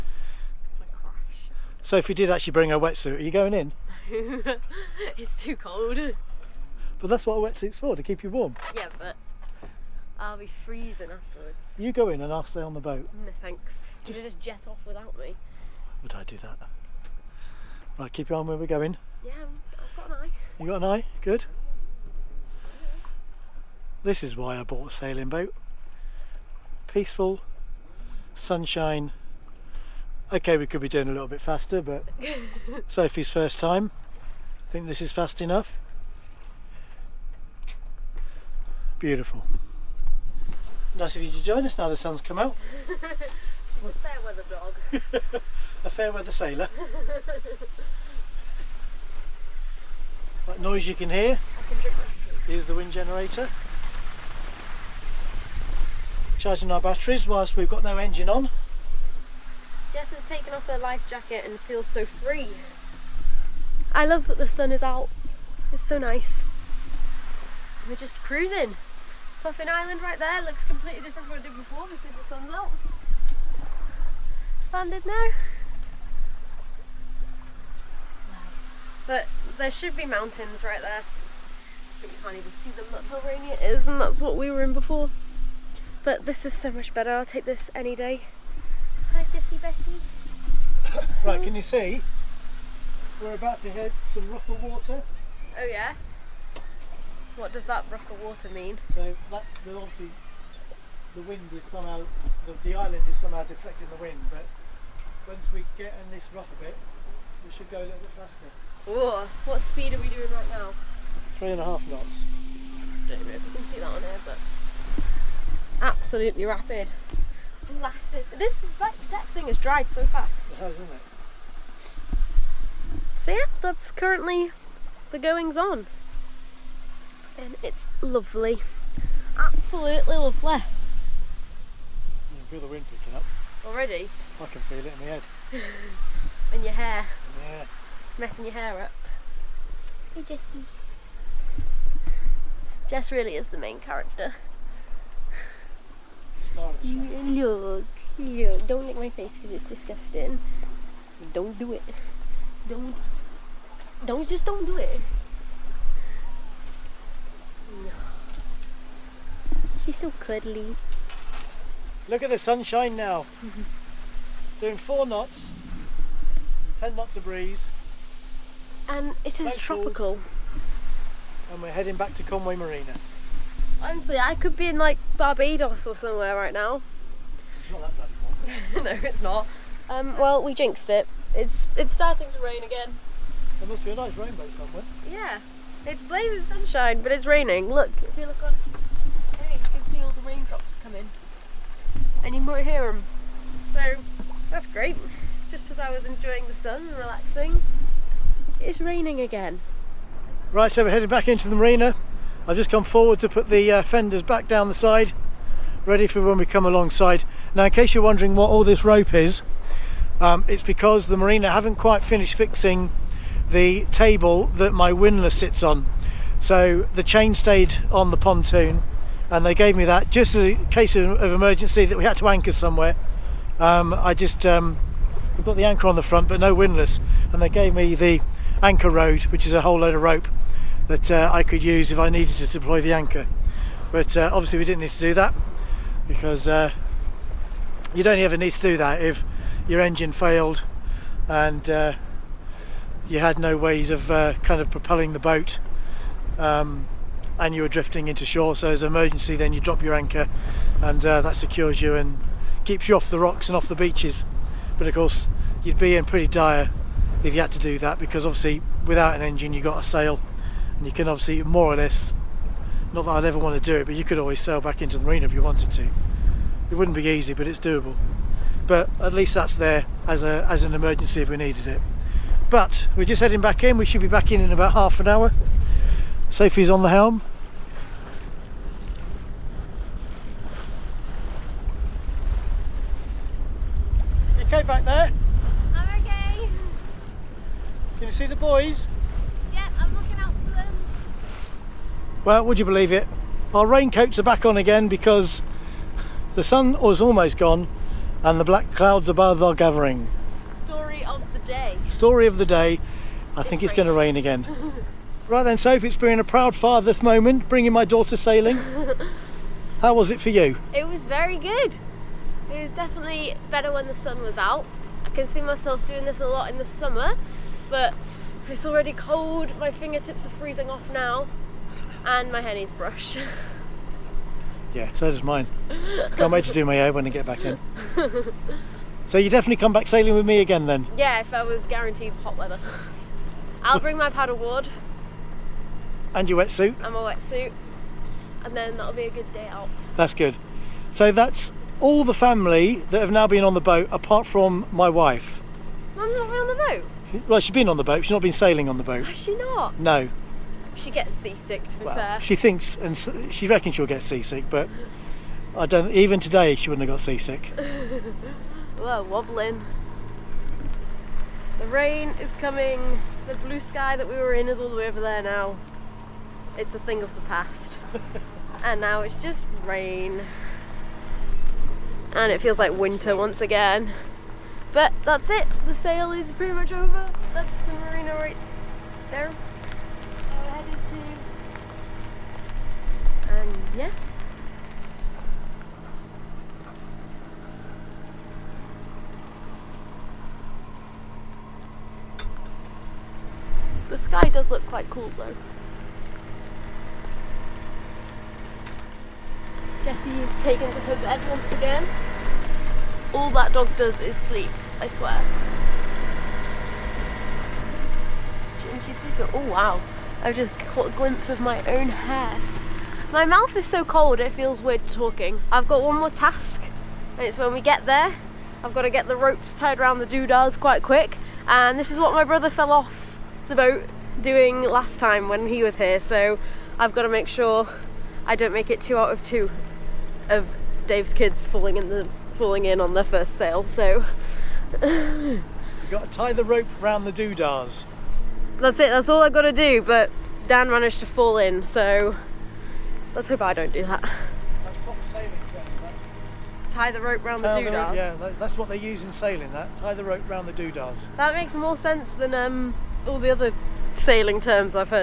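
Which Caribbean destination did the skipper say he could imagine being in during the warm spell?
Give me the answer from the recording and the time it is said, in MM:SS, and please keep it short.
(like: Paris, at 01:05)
Barbados, at 02:55.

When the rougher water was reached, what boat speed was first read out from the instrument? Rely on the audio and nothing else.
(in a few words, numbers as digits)
3.5 knots.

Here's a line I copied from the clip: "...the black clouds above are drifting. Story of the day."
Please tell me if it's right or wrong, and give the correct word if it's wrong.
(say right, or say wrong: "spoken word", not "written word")
wrong: "gathering", not "drifting".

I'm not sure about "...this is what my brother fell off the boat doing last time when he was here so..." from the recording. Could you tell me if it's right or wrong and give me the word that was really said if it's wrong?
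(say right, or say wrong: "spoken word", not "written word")
right.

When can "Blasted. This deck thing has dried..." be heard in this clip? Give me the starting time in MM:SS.
01:57.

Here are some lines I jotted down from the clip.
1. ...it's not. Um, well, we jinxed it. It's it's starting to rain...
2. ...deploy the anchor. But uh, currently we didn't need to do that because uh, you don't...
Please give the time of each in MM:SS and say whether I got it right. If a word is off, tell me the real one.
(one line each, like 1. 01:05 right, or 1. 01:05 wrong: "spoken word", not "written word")
1. 02:59 right
2. 03:52 wrong: "obviously", not "currently".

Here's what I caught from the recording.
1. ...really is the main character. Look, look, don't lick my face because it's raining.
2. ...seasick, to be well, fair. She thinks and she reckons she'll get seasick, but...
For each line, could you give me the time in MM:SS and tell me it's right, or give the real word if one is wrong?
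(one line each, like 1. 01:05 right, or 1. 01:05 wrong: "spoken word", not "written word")
1. 02:23 wrong: "disgusting", not "raining"
2. 05:51 right.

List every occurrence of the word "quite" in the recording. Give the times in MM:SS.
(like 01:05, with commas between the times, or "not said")
03:31, 06:34, 07:00.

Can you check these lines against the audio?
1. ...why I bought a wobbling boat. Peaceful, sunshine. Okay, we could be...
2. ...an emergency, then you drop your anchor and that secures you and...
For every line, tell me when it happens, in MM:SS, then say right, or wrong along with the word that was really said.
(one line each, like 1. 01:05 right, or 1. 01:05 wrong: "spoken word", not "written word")
1. 00:24 wrong: "sailing", not "wobbling"
2. 04:08 right.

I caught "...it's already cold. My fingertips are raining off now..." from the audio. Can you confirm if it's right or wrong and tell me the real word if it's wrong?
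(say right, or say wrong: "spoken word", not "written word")
wrong: "freezing", not "raining".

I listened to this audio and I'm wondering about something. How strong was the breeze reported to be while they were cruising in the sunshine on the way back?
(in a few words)
10 knots.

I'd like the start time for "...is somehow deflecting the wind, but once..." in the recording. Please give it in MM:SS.
01:43.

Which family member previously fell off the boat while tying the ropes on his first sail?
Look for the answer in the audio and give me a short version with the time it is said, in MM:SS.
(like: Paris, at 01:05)
Dan, at 07:20.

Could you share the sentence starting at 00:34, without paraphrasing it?
I think this is fast enough.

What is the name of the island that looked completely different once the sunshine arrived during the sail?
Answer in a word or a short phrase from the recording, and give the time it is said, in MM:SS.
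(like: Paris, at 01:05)
Puffin Island, at 01:09.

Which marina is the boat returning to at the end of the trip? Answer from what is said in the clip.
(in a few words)
Conwy Marina.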